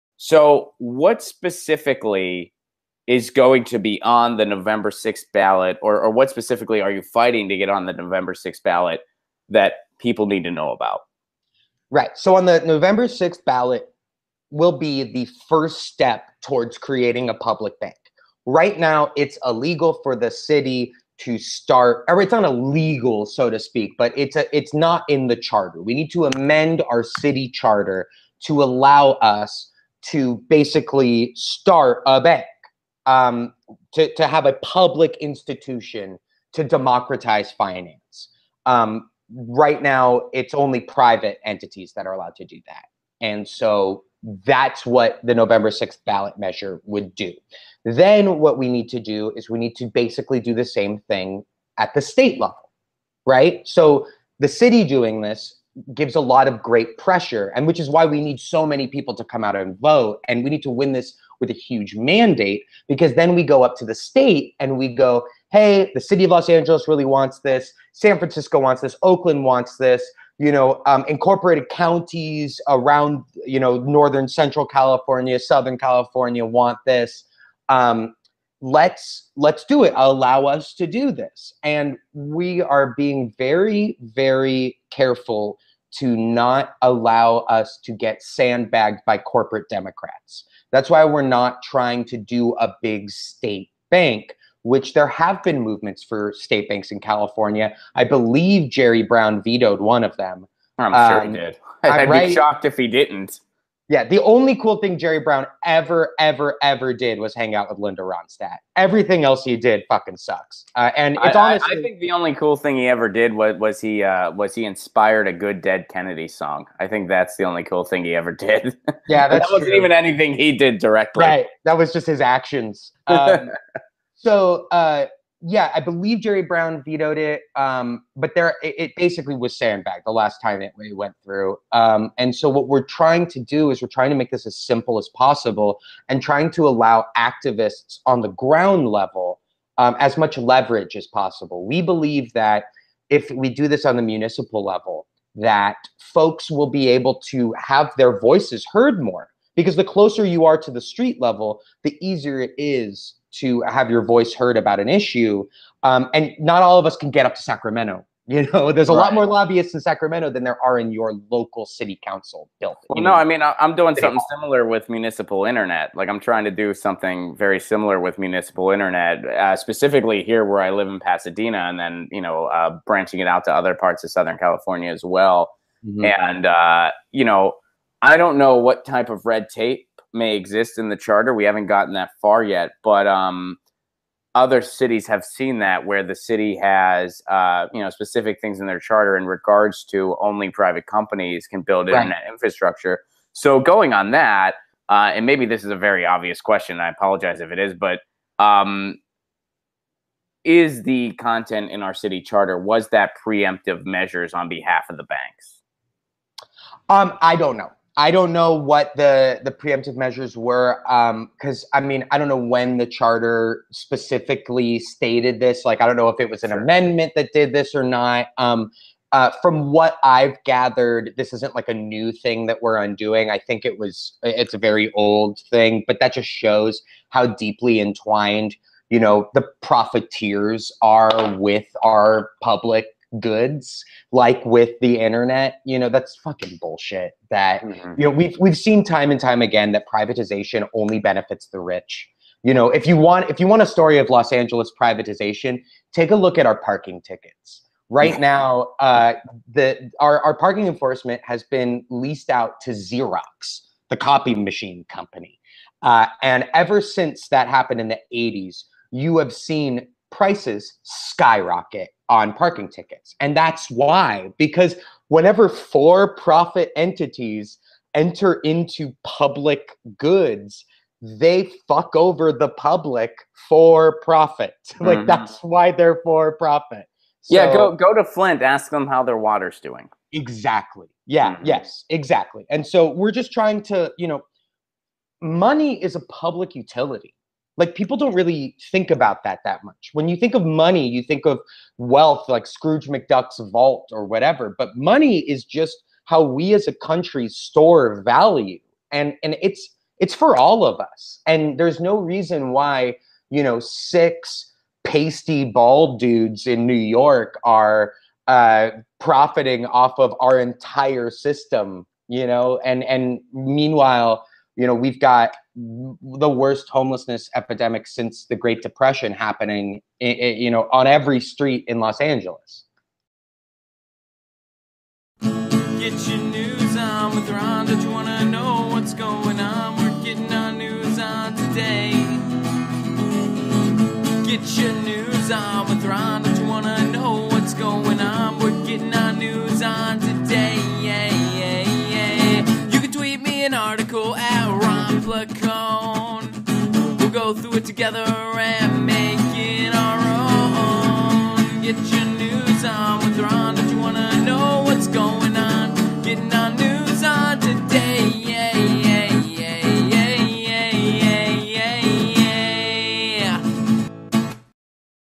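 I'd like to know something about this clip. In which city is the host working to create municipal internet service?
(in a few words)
Pasadena.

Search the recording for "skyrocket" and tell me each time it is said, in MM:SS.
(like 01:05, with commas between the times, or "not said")
04:20.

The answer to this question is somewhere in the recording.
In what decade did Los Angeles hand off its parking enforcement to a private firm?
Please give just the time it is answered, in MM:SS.
04:18.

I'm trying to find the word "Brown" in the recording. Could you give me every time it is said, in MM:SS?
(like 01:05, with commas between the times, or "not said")
01:39, 01:45, 02:06.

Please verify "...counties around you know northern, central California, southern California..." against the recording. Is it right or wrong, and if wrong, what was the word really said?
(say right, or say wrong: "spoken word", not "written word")
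right.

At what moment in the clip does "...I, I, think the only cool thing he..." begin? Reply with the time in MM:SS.
01:51.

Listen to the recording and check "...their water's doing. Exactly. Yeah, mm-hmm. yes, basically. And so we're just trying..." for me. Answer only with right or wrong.
wrong.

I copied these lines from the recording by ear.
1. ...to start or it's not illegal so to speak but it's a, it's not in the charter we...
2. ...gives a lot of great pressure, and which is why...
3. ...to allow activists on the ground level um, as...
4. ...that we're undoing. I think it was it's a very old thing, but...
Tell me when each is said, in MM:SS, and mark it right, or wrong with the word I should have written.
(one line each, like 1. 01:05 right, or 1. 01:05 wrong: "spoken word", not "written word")
1. 00:21 right
2. 00:55 right
3. 02:16 right
4. 03:42 right.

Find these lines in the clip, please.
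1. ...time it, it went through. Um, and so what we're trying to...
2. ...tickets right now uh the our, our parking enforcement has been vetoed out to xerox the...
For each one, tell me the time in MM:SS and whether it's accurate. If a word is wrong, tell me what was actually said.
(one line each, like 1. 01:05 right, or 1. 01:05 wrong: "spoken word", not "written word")
1. 02:10 right
2. 04:07 wrong: "leased", not "vetoed".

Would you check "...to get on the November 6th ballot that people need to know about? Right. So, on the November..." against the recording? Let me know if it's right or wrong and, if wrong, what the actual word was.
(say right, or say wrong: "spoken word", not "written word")
right.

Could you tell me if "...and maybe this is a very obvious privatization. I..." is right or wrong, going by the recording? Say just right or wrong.
wrong.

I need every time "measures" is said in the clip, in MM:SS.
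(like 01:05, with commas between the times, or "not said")
00:46, 03:23, 03:29.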